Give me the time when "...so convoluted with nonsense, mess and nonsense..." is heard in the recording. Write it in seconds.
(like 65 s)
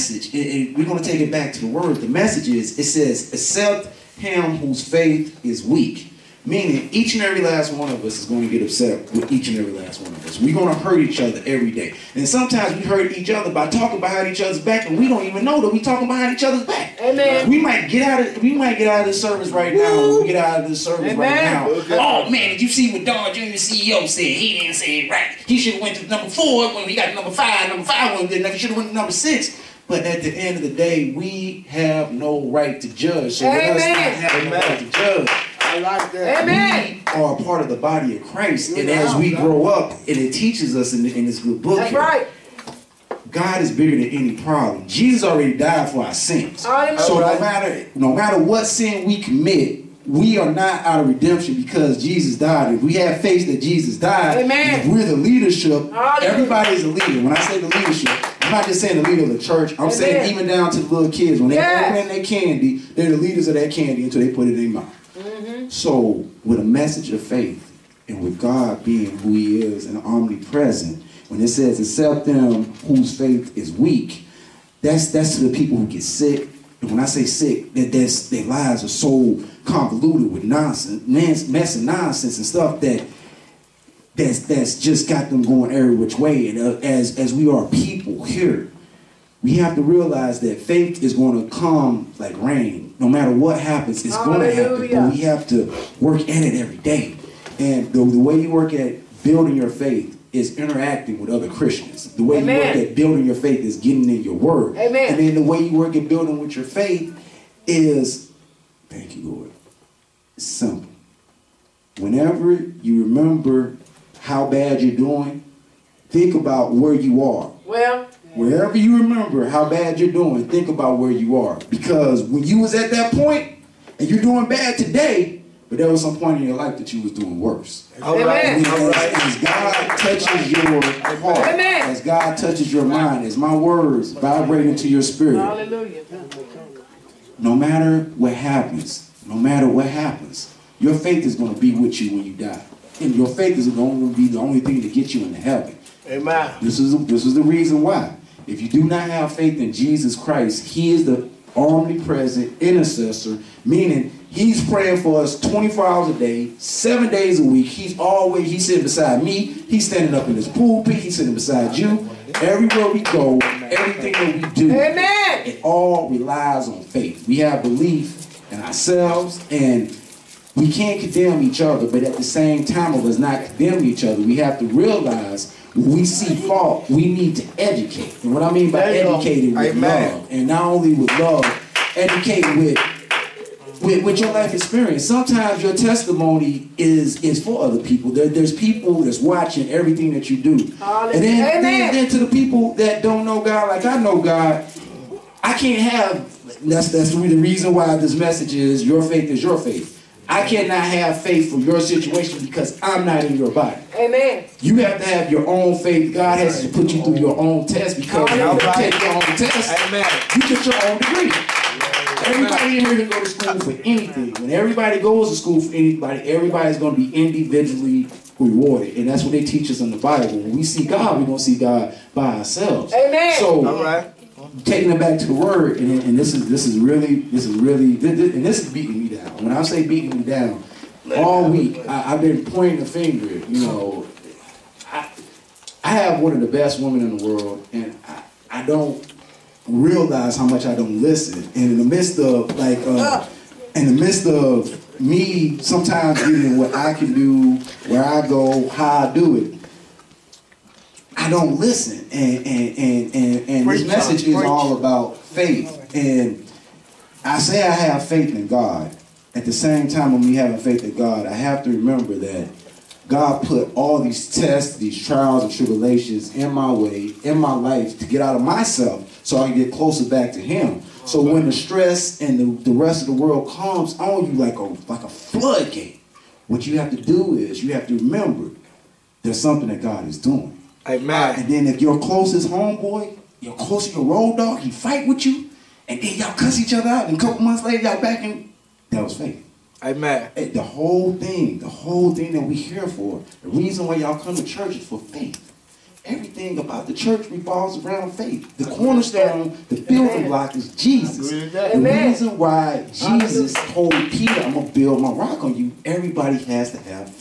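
79 s.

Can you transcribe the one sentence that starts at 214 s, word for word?
When everybody goes to school for anybody, everybody's going to be individually rewarded.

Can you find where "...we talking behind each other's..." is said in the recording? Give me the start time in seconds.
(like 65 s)
15 s.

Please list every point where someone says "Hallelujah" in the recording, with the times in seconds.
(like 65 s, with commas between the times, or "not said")
55 s, 135 s.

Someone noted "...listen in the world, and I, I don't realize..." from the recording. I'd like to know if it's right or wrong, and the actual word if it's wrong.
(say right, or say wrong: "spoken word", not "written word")
wrong: "women", not "listen".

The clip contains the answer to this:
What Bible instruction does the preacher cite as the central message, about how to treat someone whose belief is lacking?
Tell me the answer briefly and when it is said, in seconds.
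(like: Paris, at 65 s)
Accept him whose faith is weak, at 3 s.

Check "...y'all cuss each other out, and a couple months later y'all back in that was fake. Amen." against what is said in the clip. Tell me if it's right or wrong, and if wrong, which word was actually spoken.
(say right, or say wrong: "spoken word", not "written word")
right.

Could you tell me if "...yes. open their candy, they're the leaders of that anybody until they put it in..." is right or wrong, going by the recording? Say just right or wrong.
wrong.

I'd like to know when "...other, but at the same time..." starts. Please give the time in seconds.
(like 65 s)
171 s.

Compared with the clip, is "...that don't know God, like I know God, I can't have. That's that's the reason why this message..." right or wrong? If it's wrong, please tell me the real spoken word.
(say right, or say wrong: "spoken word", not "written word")
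right.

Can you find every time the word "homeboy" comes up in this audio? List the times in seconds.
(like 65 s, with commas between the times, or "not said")
282 s.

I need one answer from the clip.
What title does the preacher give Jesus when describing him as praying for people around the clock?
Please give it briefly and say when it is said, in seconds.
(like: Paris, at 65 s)
Omnipresent intercessor, at 151 s.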